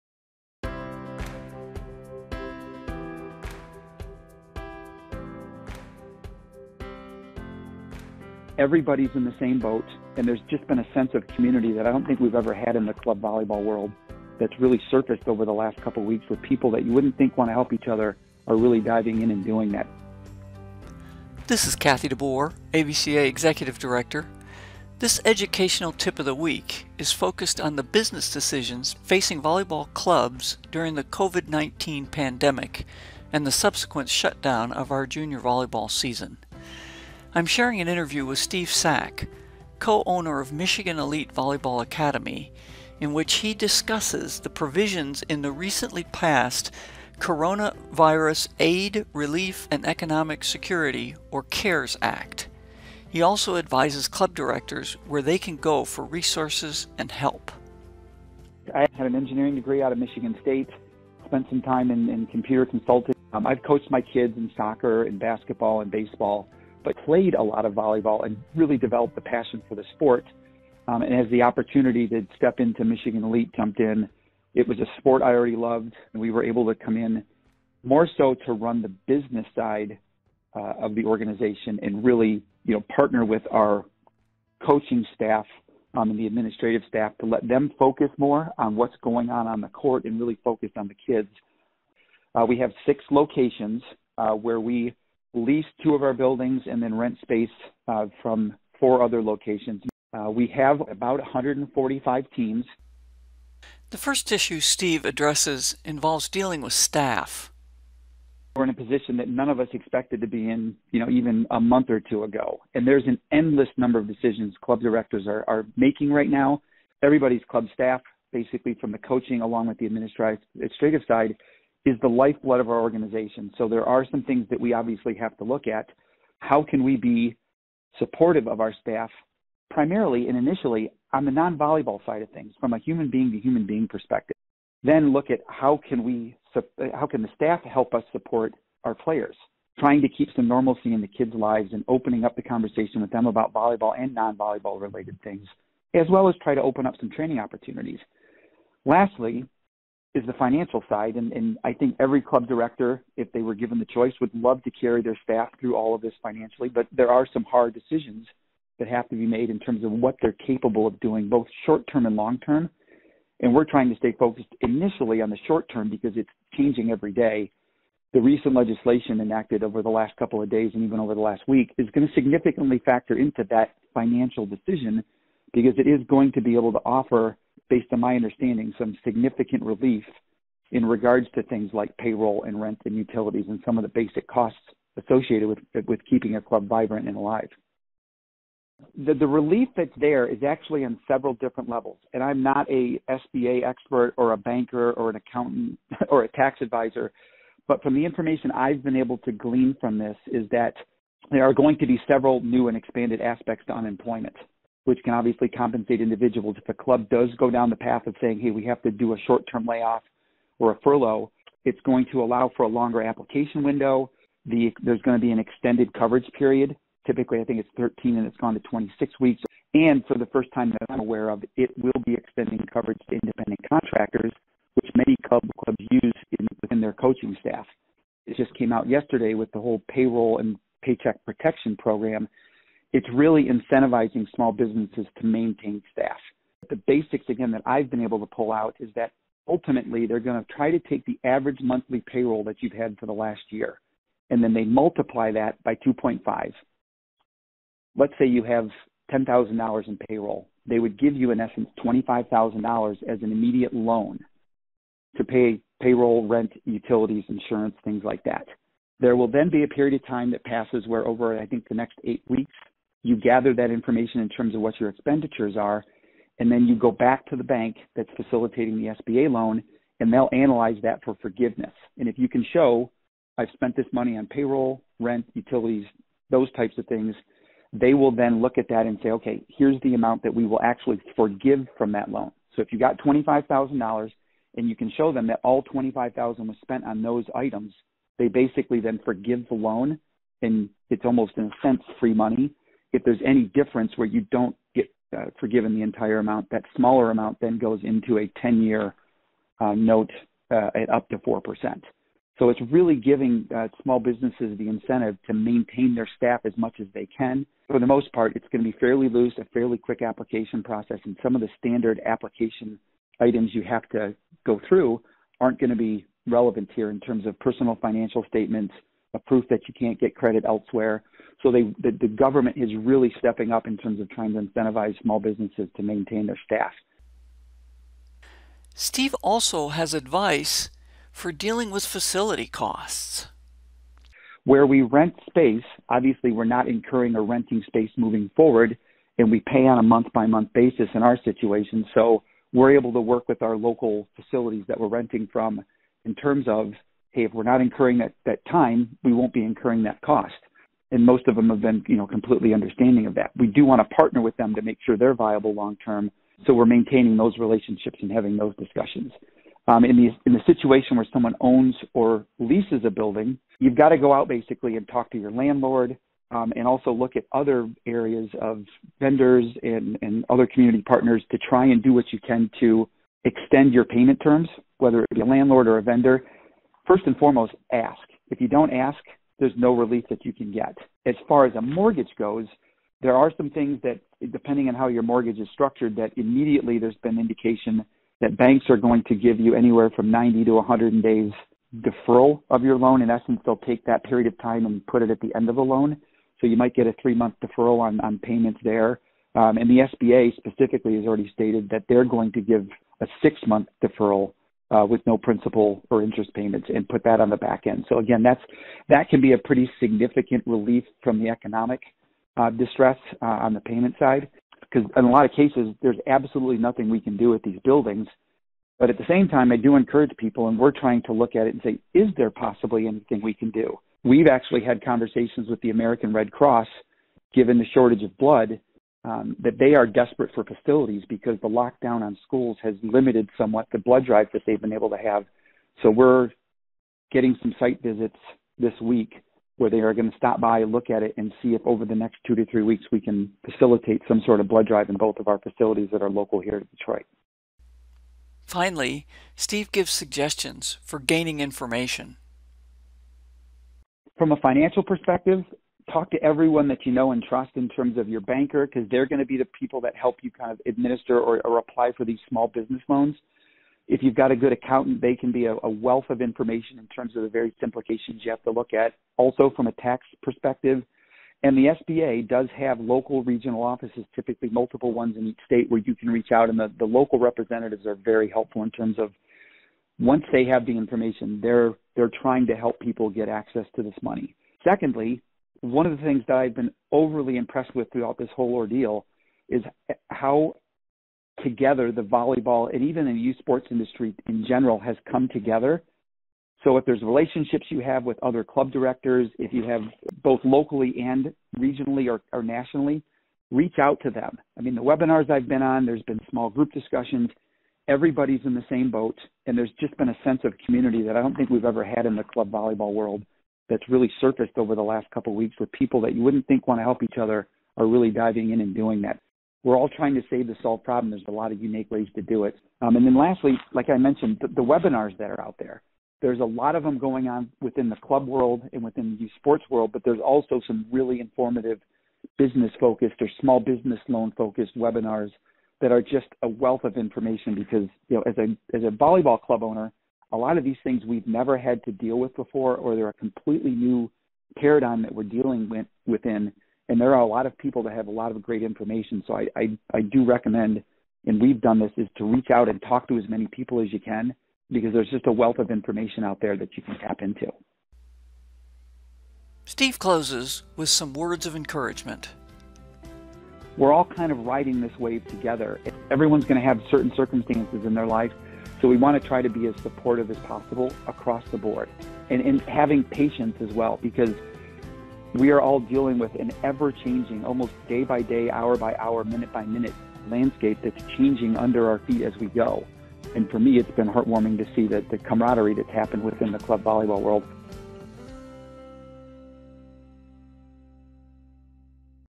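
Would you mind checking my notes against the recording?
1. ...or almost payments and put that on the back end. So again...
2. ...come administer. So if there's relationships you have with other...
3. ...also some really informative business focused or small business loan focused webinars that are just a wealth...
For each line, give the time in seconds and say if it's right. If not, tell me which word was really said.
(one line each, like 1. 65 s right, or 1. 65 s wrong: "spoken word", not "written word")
1. 405 s wrong: "interest", not "almost"
2. 495 s wrong: "together", not "administer"
3. 530 s right.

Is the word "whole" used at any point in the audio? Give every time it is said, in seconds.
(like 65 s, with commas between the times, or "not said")
229 s, 488 s.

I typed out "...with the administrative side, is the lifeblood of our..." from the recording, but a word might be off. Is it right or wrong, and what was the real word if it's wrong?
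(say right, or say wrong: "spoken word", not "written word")
right.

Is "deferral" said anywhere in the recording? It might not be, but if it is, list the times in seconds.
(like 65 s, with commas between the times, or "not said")
391 s, 397 s, 403 s.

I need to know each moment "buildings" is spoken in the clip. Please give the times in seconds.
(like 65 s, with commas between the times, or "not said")
96 s, 362 s, 417 s.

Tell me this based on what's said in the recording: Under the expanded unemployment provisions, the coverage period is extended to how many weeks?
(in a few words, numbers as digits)
26.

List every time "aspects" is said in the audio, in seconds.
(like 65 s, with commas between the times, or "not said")
203 s.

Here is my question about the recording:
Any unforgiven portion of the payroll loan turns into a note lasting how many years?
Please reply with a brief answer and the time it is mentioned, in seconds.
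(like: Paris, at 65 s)
10, at 298 s.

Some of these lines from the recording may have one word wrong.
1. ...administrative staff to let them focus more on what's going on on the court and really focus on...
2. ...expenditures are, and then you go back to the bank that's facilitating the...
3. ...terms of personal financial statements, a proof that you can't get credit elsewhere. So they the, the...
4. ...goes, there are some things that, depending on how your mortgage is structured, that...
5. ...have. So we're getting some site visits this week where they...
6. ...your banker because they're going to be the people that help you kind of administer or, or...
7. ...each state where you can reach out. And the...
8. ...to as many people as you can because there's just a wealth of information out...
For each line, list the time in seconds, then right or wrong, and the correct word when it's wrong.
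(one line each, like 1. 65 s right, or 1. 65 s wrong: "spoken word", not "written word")
1. 86 s right
2. 264 s right
3. 316 s right
4. 382 s right
5. 434 s right
6. 458 s right
7. 475 s right
8. 553 s right.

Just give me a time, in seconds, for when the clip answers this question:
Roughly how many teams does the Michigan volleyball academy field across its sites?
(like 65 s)
101 s.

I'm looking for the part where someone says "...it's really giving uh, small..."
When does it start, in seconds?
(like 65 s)
302 s.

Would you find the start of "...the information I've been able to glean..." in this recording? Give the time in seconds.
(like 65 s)
197 s.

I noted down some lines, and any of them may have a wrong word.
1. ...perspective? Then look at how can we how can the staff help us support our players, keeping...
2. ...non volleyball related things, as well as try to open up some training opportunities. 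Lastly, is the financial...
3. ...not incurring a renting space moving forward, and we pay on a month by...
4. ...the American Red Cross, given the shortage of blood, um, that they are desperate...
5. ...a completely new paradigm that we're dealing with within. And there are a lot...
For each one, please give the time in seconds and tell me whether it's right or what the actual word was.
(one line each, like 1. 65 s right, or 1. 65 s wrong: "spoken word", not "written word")
1. 133 s wrong: "trying", not "keeping"
2. 144 s right
3. 336 s right
4. 425 s right
5. 543 s right.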